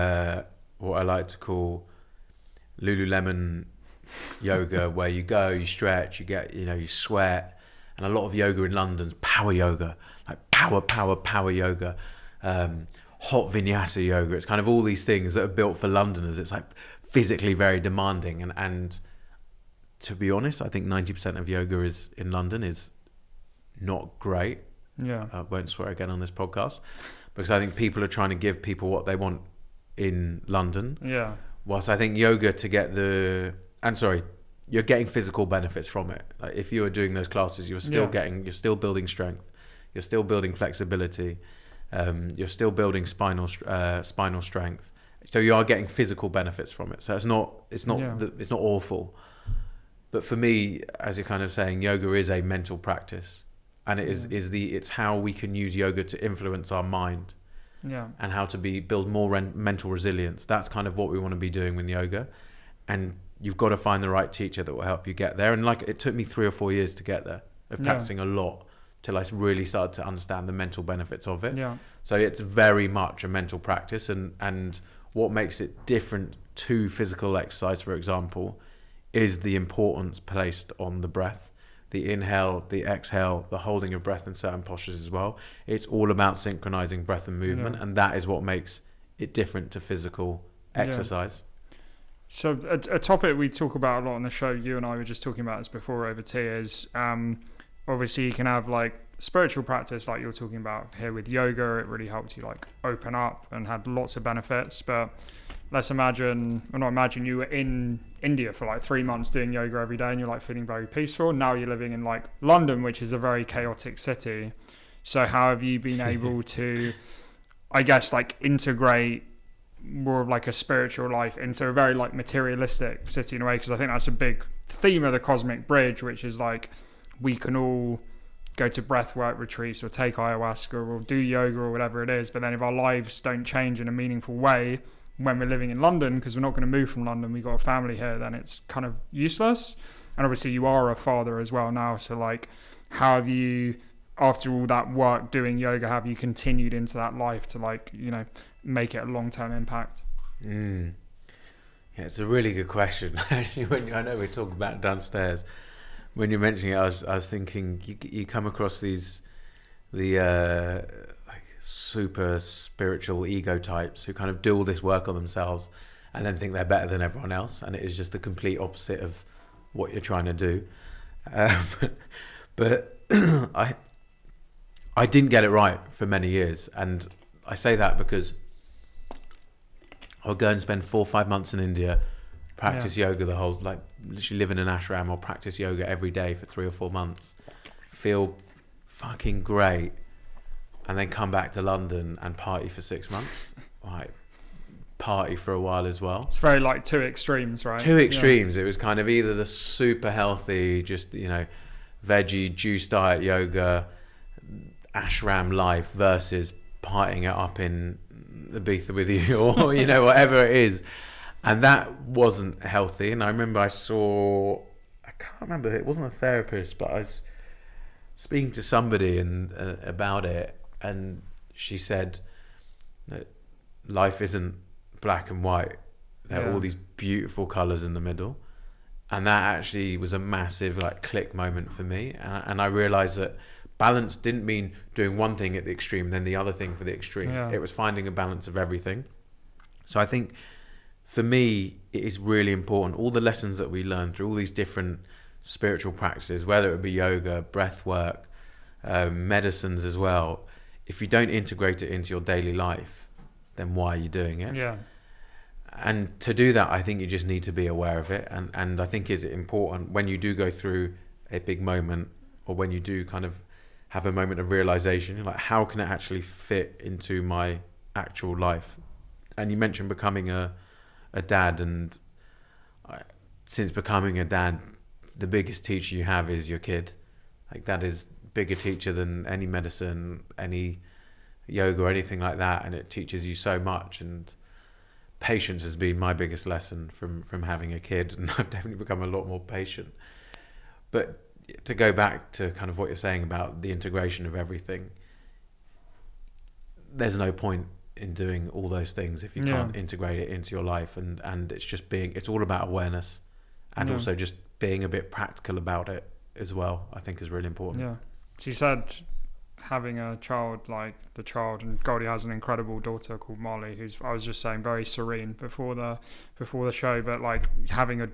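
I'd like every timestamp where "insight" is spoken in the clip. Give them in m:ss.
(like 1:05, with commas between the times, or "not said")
not said.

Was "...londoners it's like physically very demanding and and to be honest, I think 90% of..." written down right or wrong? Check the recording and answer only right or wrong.
right.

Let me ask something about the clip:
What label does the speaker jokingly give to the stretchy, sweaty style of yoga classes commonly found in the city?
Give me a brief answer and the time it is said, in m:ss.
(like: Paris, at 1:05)
Lululemon yoga, at 0:02.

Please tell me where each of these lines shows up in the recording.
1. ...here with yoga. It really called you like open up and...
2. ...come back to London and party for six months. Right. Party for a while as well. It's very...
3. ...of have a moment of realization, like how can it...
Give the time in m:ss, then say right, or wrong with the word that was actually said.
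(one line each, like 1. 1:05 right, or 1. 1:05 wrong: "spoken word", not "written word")
1. 1:40 wrong: "helped", not "called"
2. 3:11 right
3. 4:23 right.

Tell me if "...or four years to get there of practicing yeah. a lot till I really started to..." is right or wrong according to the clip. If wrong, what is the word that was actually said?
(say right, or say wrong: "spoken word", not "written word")
right.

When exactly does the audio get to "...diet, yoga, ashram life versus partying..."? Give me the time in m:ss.
3:22.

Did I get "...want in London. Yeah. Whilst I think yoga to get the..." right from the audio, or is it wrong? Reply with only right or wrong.
right.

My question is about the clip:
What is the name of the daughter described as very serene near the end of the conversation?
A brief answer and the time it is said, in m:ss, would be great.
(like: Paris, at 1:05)
Molly, at 5:13.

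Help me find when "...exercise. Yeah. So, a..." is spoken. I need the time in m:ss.
1:30.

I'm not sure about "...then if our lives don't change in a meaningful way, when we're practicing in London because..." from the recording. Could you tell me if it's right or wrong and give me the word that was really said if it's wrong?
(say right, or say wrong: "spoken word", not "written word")
wrong: "living", not "practicing".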